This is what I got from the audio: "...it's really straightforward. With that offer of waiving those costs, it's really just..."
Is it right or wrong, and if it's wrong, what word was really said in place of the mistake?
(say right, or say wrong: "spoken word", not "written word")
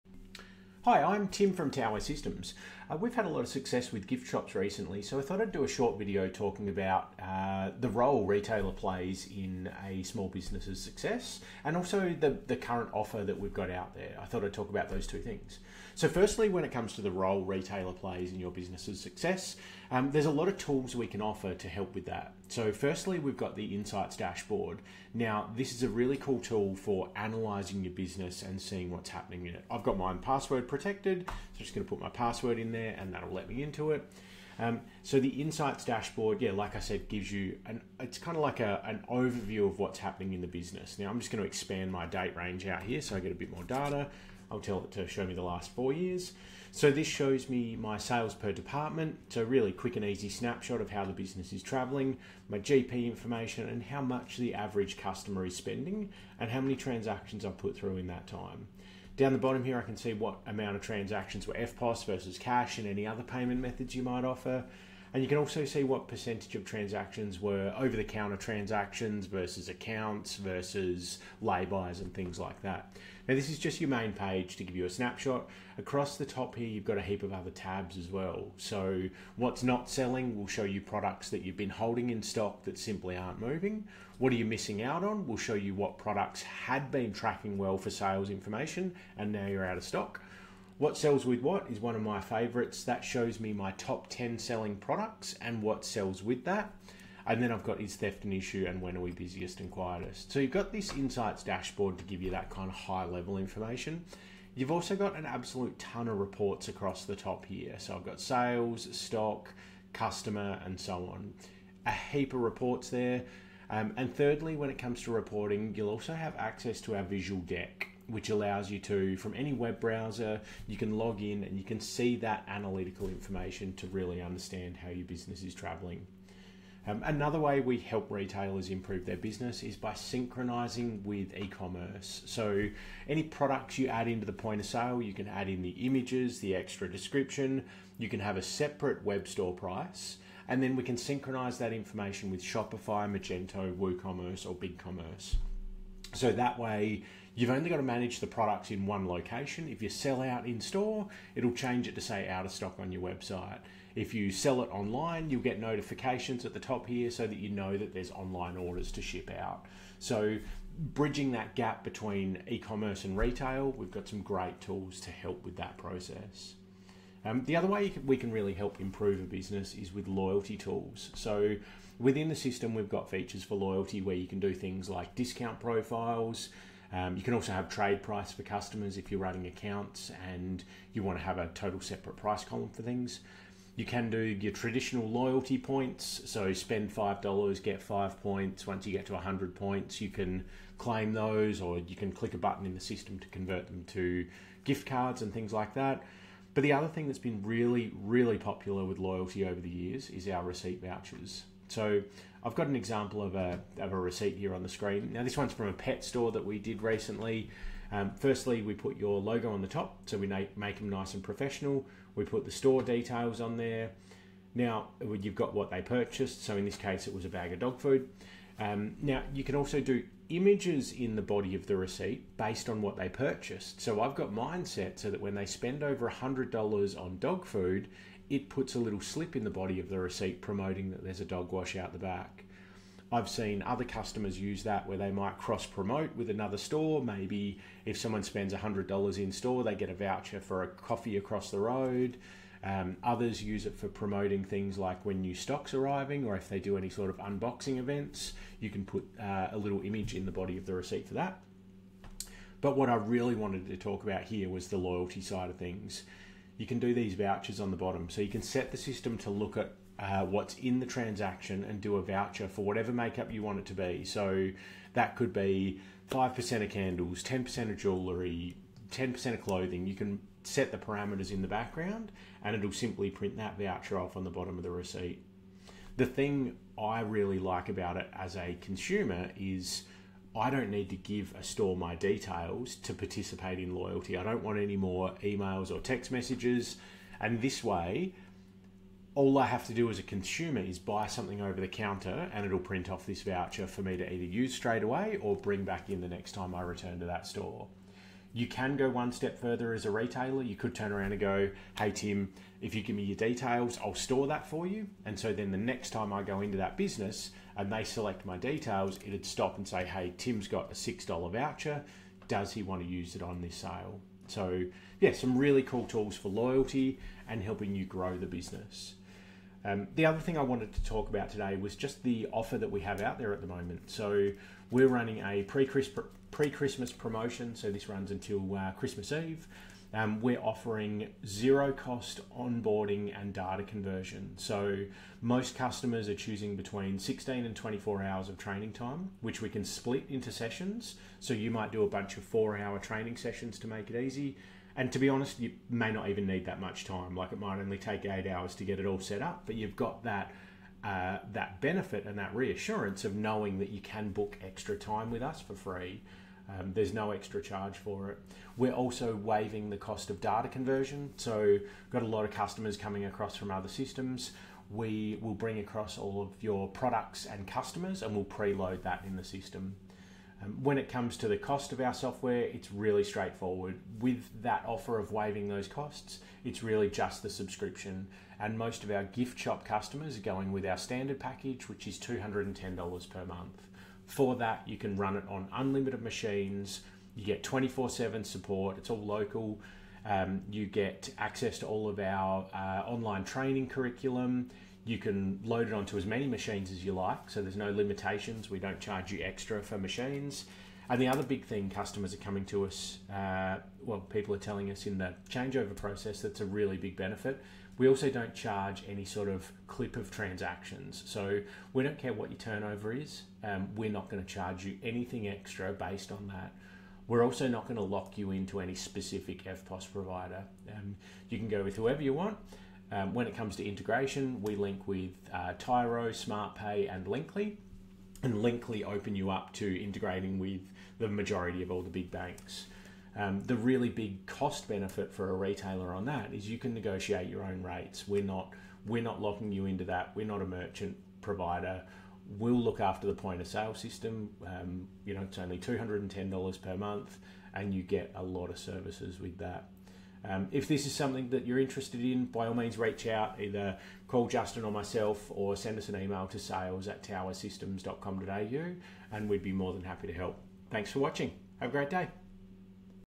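right.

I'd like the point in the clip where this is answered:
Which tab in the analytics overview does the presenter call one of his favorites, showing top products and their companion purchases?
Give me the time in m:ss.
1:30.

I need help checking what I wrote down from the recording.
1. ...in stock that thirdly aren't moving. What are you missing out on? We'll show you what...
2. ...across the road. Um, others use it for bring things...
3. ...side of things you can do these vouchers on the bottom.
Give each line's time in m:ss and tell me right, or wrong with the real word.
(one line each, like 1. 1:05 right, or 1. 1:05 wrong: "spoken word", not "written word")
1. 1:22 wrong: "simply", not "thirdly"
2. 4:01 wrong: "promoting", not "bring"
3. 4:15 right.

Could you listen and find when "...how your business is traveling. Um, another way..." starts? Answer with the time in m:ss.
2:04.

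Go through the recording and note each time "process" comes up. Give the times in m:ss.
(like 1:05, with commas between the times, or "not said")
2:45, 6:45.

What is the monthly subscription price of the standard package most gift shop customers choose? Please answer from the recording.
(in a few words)
$210.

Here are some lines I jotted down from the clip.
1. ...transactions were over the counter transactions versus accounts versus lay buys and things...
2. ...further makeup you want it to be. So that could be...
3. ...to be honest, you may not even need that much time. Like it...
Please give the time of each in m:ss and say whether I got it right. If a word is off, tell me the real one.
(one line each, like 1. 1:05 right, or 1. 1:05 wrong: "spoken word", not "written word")
1. 1:06 right
2. 4:22 wrong: "whatever", not "further"
3. 5:44 right.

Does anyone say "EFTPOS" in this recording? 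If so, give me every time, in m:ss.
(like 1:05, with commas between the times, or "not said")
1:01, 6:59.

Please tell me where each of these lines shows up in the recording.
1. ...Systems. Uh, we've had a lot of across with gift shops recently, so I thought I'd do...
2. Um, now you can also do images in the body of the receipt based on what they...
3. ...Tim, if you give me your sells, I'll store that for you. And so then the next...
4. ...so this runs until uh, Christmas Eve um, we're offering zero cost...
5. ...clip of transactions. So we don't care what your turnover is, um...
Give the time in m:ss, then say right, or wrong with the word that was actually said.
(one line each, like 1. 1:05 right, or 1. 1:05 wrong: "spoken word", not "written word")
1. 0:01 wrong: "success", not "across"
2. 3:38 right
3. 5:01 wrong: "details", not "sells"
4. 5:27 right
5. 6:49 right.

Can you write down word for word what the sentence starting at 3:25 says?
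Now this one's from a pet store that we did recently.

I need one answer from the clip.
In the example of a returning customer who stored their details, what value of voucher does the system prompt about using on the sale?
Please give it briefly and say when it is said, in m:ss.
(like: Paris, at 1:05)
$6, at 5:10.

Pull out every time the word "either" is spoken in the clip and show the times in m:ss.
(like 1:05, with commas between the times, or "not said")
4:54, 7:33.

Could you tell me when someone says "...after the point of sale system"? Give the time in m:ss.
7:22.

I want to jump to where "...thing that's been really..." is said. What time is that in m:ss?
3:16.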